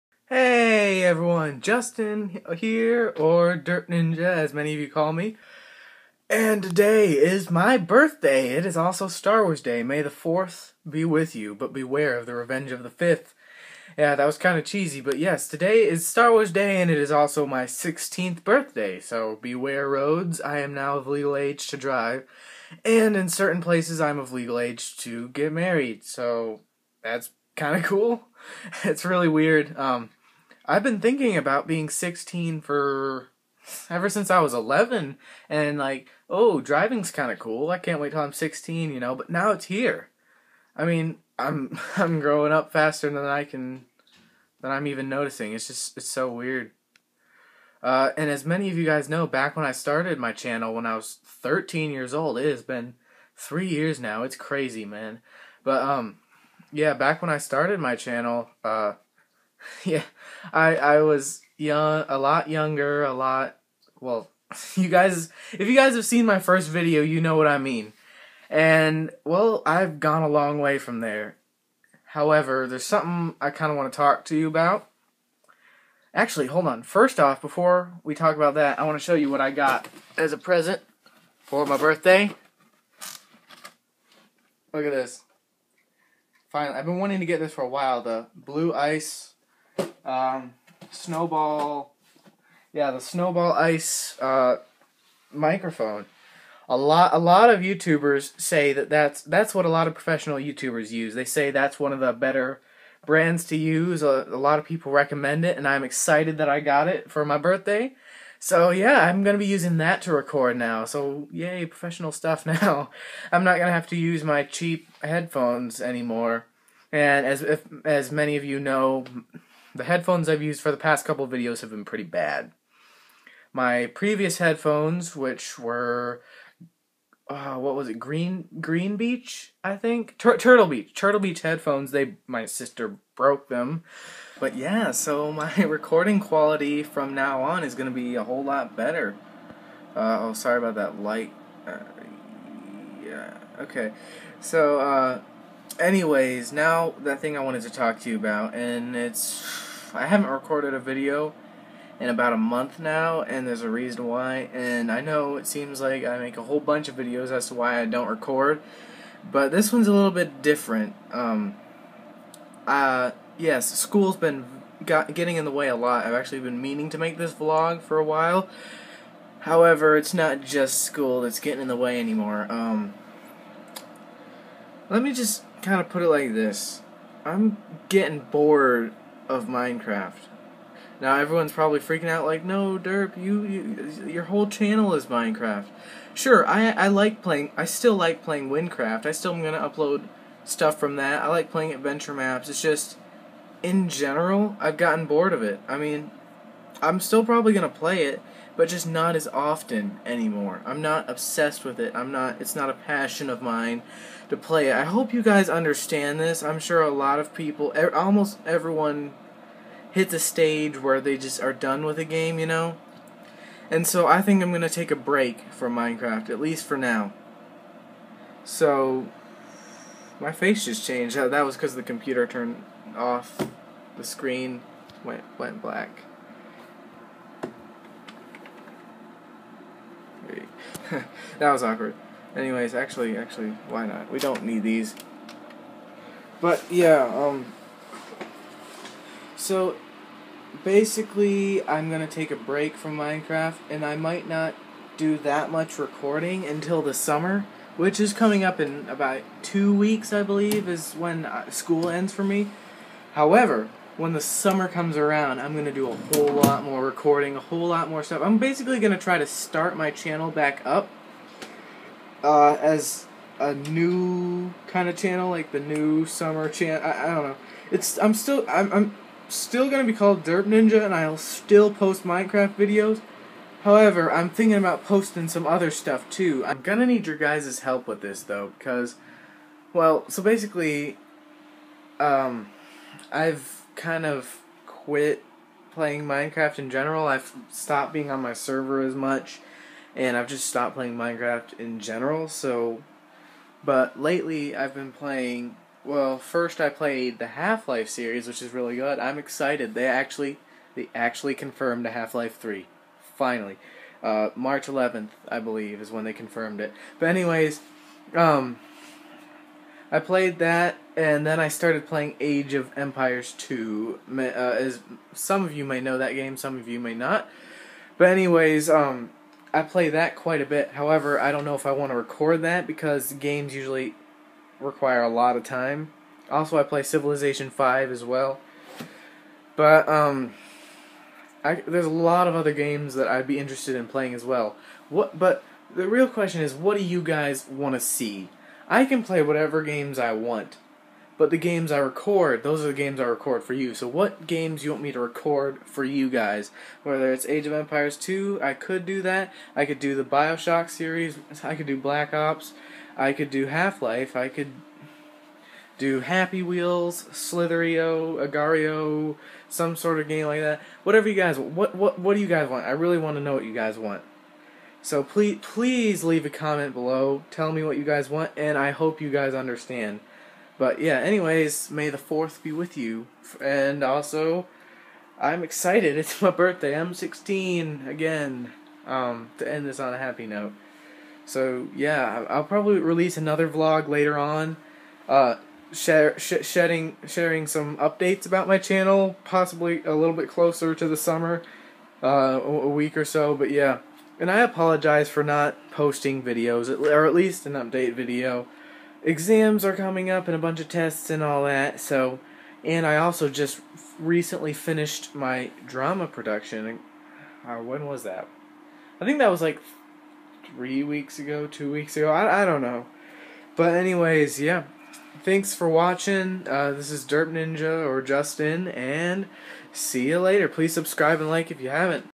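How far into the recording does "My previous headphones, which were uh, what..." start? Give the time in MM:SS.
02:03.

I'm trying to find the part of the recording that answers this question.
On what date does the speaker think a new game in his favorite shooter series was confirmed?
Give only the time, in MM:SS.
05:04.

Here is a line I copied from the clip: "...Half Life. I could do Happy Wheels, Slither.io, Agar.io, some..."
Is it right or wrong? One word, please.
right.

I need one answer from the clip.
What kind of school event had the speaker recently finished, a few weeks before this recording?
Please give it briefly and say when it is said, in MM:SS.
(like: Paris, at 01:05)
drama production, at 06:45.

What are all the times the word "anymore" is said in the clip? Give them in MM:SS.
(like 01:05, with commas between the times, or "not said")
01:55, 02:51, 03:20.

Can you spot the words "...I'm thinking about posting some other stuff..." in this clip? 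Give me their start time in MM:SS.
04:34.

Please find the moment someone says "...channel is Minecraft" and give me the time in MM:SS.
03:04.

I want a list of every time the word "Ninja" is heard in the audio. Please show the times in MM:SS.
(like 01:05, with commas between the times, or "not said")
00:03, 04:30, 06:57.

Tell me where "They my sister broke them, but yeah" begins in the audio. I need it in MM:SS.
02:11.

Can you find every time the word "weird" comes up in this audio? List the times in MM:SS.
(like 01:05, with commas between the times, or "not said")
00:29, 00:46.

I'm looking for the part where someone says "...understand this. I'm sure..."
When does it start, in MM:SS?
03:25.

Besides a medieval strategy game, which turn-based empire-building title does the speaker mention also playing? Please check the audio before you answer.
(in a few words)
Civilization 5.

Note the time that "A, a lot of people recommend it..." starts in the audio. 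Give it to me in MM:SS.
01:44.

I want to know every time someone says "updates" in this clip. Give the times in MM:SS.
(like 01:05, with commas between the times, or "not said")
06:27, 06:37.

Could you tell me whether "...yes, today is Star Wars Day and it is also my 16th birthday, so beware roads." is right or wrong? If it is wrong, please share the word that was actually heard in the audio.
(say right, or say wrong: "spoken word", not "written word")
right.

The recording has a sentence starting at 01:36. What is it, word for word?
A lot, a lot of YouTubers say that that's that's what a lot of professional YouTubers use.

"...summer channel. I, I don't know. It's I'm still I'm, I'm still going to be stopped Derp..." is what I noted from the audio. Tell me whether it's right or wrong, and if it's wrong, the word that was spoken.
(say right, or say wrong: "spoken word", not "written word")
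wrong: "called", not "stopped".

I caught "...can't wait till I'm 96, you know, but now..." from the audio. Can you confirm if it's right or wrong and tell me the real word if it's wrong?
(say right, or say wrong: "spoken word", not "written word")
wrong: "16", not "96".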